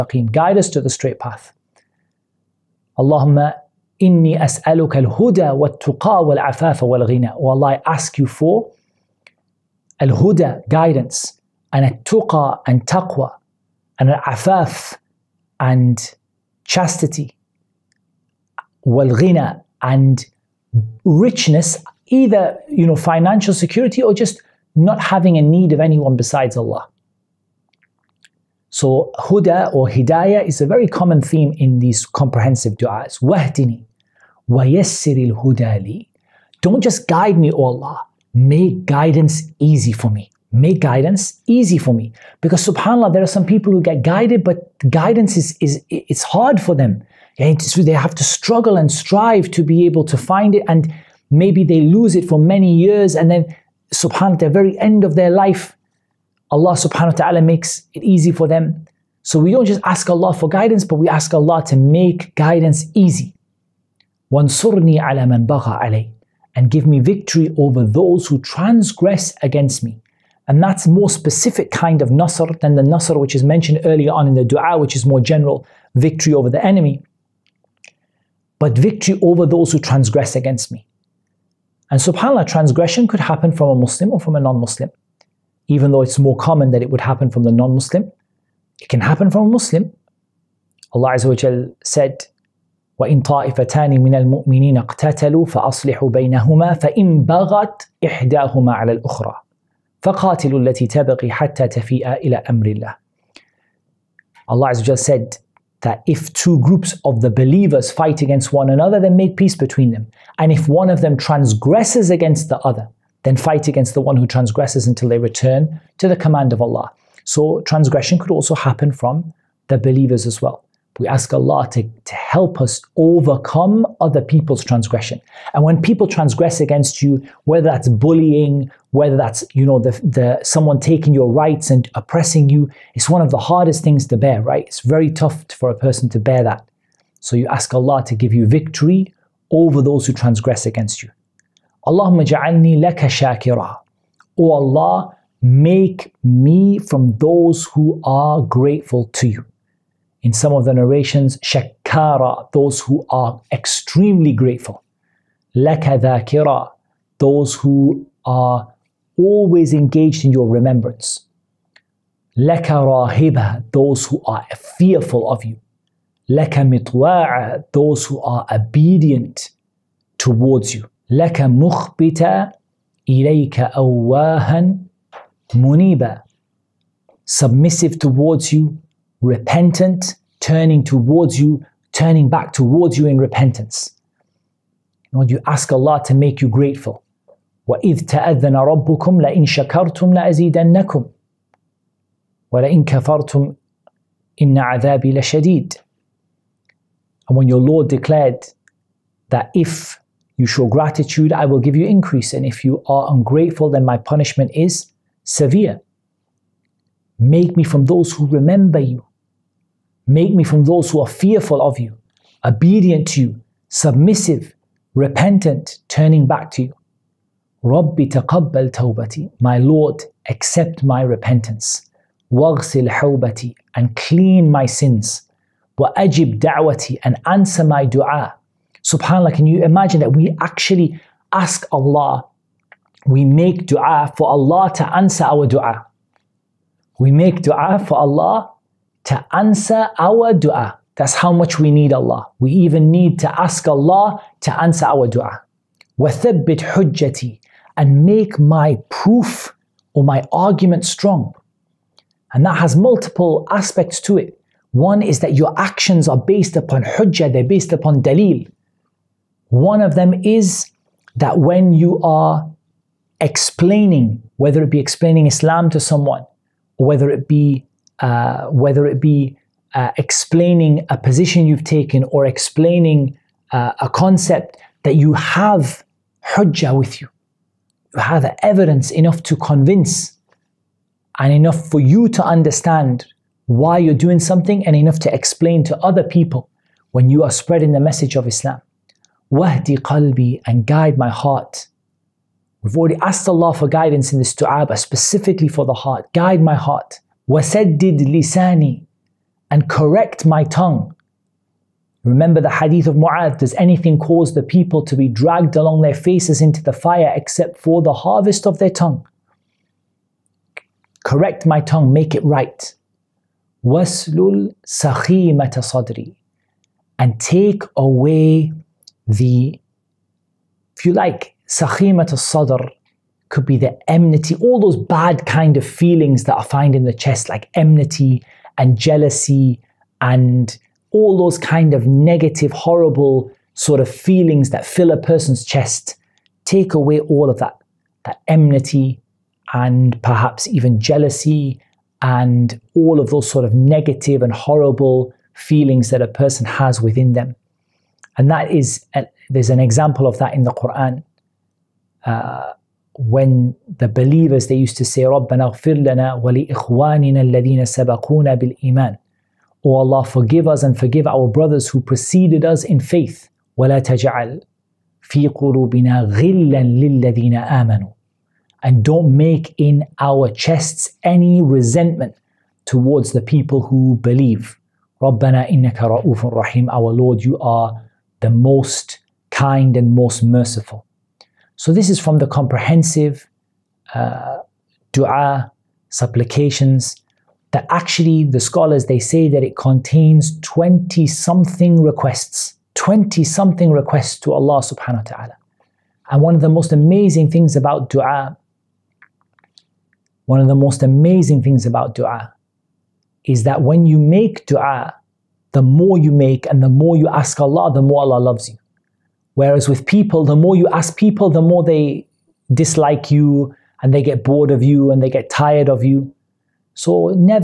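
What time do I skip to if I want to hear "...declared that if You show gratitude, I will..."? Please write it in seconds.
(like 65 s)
197 s.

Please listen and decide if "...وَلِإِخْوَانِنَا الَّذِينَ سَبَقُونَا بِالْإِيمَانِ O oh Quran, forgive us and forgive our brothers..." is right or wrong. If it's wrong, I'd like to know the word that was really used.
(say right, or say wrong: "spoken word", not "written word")
wrong: "Allah", not "Quran".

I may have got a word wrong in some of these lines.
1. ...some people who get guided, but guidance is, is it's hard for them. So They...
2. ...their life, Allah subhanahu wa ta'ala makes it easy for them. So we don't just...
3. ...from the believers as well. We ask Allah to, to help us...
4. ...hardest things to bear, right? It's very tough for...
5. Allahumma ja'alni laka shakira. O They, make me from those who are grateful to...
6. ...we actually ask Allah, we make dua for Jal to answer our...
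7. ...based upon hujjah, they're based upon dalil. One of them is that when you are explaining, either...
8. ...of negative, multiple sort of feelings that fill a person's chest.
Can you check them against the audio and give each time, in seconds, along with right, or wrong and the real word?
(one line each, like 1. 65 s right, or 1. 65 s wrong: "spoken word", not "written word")
1. 43 s right
2. 55 s right
3. 118 s right
4. 133 s right
5. 141 s wrong: "Allah", not "They"
6. 230 s wrong: "Allah", not "Jal"
7. 256 s wrong: "whether", not "either"
8. 331 s wrong: "horrible", not "multiple".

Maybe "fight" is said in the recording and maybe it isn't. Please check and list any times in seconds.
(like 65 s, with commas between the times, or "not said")
107 s, 113 s.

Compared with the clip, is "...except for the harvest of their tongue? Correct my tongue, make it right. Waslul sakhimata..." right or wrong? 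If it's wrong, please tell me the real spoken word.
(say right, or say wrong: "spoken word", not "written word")
right.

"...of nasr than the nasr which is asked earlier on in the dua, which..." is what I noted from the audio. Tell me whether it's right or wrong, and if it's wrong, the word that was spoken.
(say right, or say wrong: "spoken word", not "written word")
wrong: "mentioned", not "asked".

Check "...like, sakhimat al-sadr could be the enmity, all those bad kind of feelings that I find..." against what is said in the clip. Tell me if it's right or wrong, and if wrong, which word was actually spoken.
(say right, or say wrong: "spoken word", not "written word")
right.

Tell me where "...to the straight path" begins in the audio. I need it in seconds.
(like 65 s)
0 s.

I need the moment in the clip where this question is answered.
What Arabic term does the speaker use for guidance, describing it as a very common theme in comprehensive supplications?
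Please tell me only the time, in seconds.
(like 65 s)
29 s.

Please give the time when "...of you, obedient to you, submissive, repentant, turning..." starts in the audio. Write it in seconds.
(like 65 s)
211 s.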